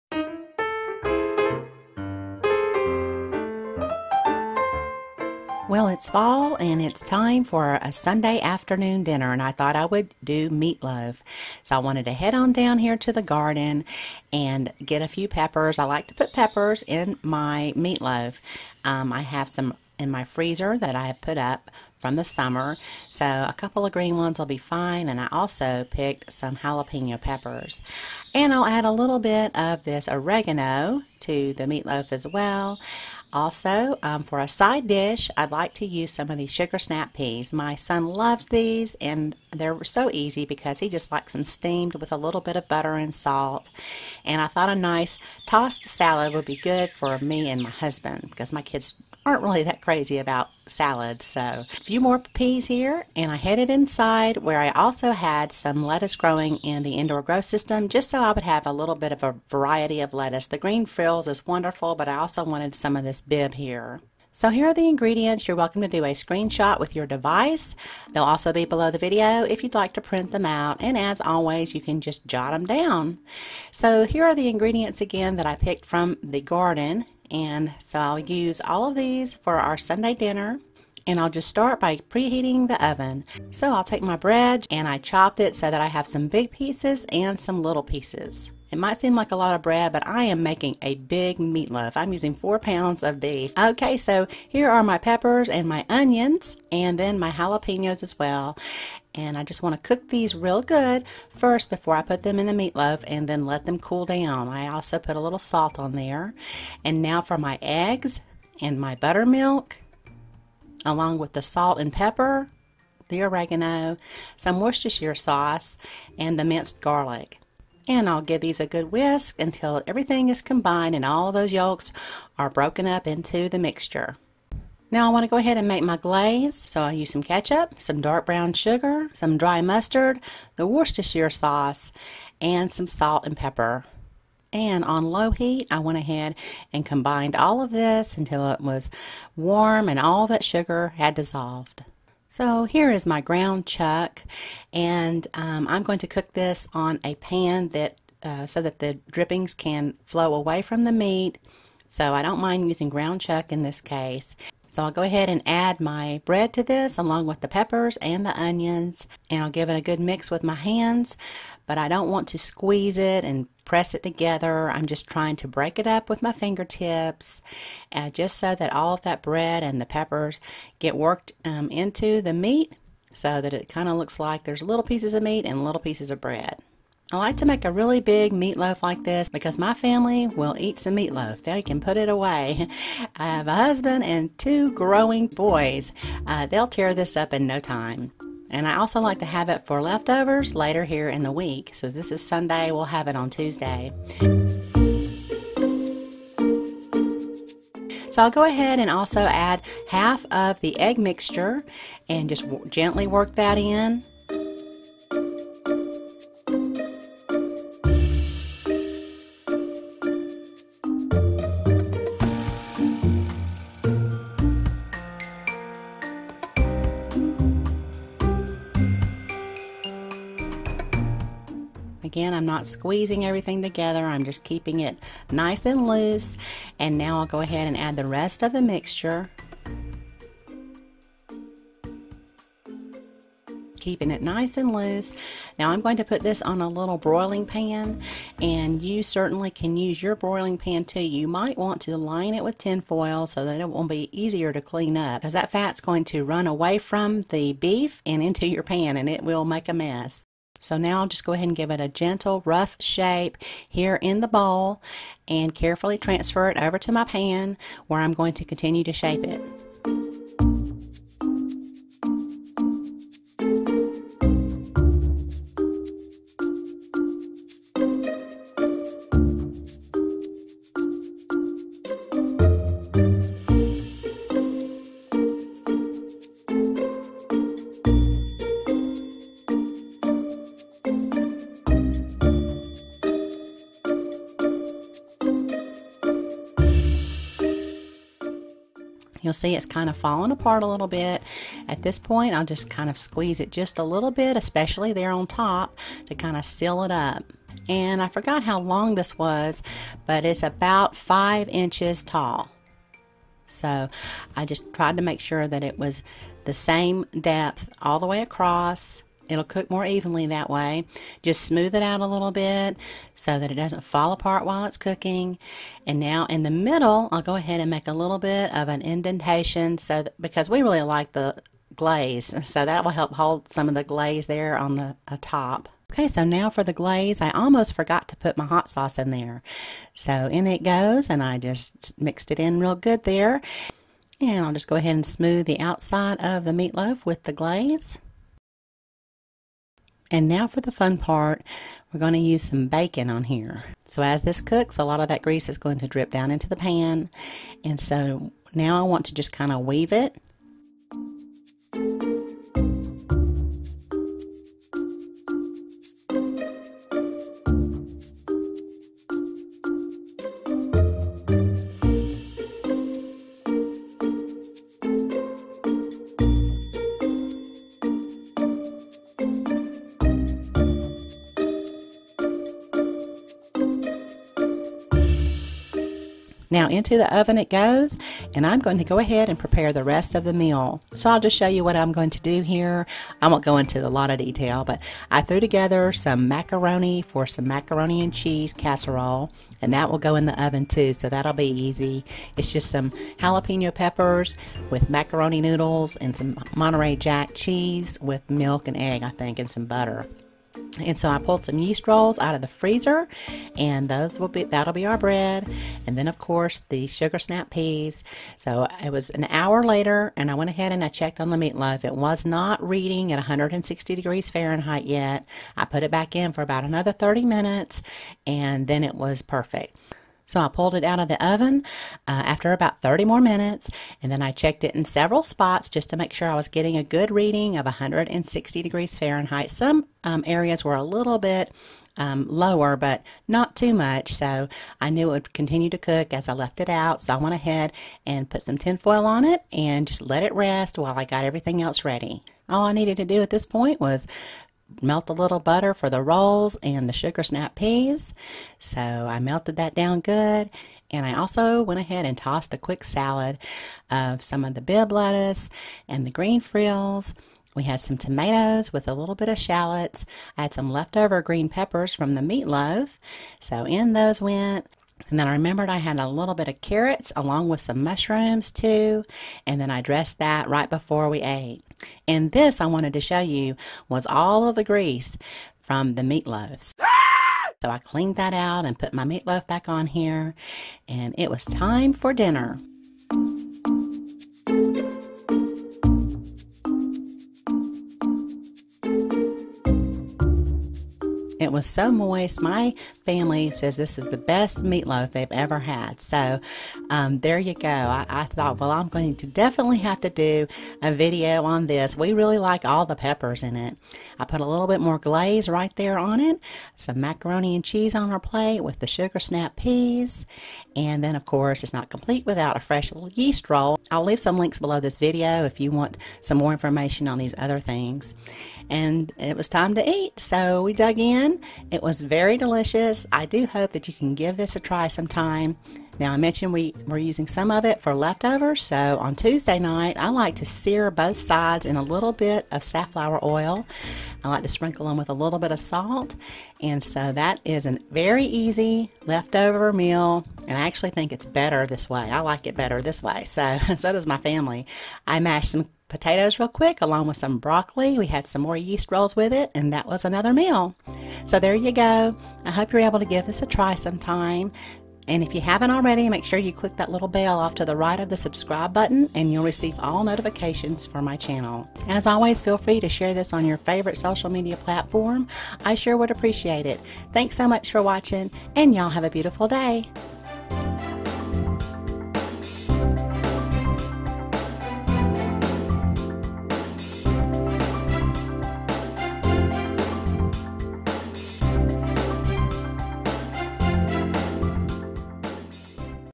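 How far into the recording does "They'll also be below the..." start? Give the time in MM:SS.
01:08.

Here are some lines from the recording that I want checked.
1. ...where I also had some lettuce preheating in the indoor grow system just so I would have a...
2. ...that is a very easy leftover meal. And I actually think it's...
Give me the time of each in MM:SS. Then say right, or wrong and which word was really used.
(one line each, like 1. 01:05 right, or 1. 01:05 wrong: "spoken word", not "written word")
1. 00:54 wrong: "growing", not "preheating"
2. 08:57 right.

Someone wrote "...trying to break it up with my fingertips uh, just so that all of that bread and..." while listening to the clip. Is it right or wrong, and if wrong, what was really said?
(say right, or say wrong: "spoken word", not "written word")
right.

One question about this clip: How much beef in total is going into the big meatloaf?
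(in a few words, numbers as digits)
4 pounds.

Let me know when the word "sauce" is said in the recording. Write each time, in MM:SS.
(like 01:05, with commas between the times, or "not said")
01:55, 02:11, 05:28.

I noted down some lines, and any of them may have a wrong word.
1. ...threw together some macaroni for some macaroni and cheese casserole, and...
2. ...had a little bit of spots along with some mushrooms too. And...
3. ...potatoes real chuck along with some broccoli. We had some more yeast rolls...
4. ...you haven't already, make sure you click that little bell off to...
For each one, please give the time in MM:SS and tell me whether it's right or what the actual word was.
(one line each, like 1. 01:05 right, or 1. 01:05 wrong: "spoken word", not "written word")
1. 06:25 right
2. 07:45 wrong: "carrots", not "spots"
3. 09:05 wrong: "quick", not "chuck"
4. 09:15 right.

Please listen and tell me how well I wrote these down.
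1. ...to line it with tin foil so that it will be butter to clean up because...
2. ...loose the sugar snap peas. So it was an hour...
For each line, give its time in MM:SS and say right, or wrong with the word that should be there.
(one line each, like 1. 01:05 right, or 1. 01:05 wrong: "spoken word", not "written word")
1. 04:01 wrong: "easier", not "butter"
2. 06:46 wrong: "course", not "loose".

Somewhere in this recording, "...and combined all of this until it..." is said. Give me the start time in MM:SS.
02:16.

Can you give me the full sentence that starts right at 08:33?
I'll leave some links below this video if you want some more information on these other things.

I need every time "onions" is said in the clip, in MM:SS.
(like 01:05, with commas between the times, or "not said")
01:35, 02:38.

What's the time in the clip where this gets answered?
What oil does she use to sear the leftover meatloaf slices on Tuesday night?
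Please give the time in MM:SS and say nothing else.
08:52.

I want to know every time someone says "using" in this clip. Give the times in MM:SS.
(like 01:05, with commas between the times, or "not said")
01:32, 02:32, 08:46.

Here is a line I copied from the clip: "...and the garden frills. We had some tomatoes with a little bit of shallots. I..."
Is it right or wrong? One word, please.
wrong.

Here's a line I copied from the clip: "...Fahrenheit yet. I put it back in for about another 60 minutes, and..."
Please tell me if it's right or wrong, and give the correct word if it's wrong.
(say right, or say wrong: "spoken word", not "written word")
wrong: "30", not "60".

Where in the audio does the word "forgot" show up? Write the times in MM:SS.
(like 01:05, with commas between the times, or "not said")
04:58, 05:27.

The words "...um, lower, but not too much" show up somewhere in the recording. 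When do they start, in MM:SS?
07:11.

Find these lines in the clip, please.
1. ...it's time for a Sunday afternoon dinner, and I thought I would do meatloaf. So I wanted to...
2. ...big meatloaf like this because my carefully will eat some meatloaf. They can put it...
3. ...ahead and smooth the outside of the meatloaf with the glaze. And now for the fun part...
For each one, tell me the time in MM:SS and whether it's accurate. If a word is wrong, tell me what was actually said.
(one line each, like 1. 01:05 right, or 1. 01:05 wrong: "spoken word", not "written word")
1. 00:06 right
2. 02:58 wrong: "family", not "carefully"
3. 05:34 right.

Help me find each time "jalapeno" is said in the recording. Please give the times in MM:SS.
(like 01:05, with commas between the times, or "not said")
00:26, 01:37, 06:33.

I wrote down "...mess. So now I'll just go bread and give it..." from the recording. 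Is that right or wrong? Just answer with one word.
wrong.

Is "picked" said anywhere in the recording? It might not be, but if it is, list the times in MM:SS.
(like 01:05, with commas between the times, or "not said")
00:25, 01:15.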